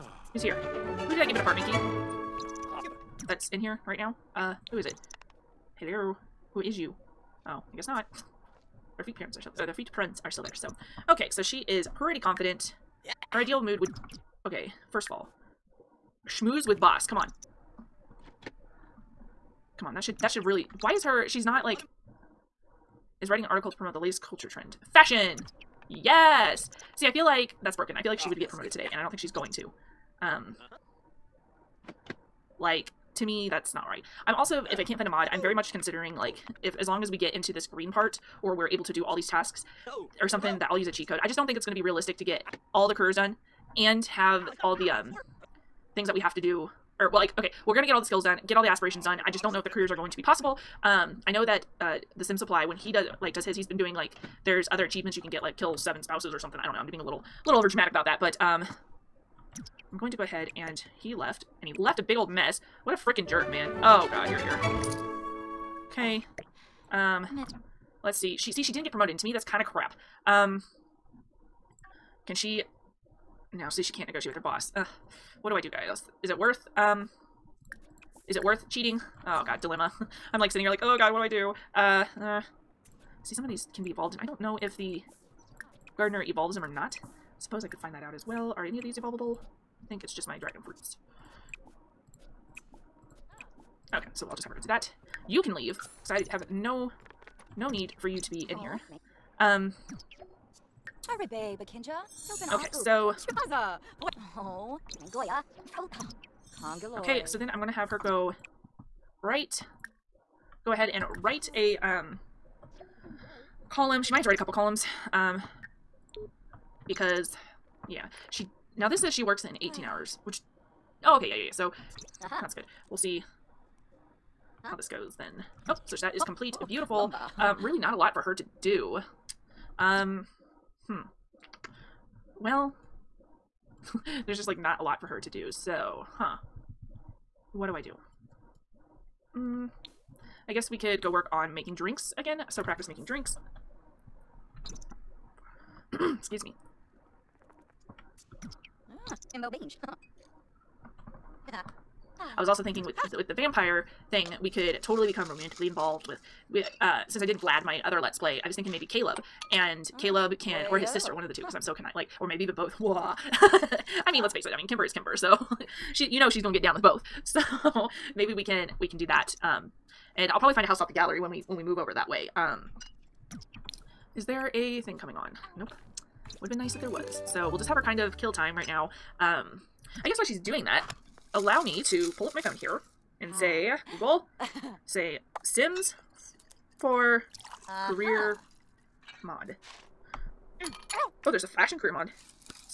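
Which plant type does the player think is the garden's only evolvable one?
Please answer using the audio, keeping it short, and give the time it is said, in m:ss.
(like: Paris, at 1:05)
Dragon fruits, at 1:30.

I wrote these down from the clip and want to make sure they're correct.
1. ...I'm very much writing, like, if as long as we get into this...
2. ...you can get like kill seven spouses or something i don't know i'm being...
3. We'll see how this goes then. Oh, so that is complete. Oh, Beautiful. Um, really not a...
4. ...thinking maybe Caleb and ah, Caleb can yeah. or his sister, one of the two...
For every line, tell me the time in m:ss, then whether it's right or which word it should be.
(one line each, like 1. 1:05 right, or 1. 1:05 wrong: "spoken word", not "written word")
1. 0:35 wrong: "considering", not "writing"
2. 0:55 right
3. 2:02 right
4. 2:38 right.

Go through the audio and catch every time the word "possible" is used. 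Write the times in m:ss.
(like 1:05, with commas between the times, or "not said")
0:50.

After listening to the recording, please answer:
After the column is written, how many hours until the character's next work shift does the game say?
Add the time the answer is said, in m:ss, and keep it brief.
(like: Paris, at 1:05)
18, at 1:59.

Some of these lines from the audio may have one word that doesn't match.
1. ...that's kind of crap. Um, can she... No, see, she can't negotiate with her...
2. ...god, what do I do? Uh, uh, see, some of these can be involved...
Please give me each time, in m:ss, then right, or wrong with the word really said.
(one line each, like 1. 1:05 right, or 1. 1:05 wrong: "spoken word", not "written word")
1. 1:09 right
2. 1:20 wrong: "evolved", not "involved".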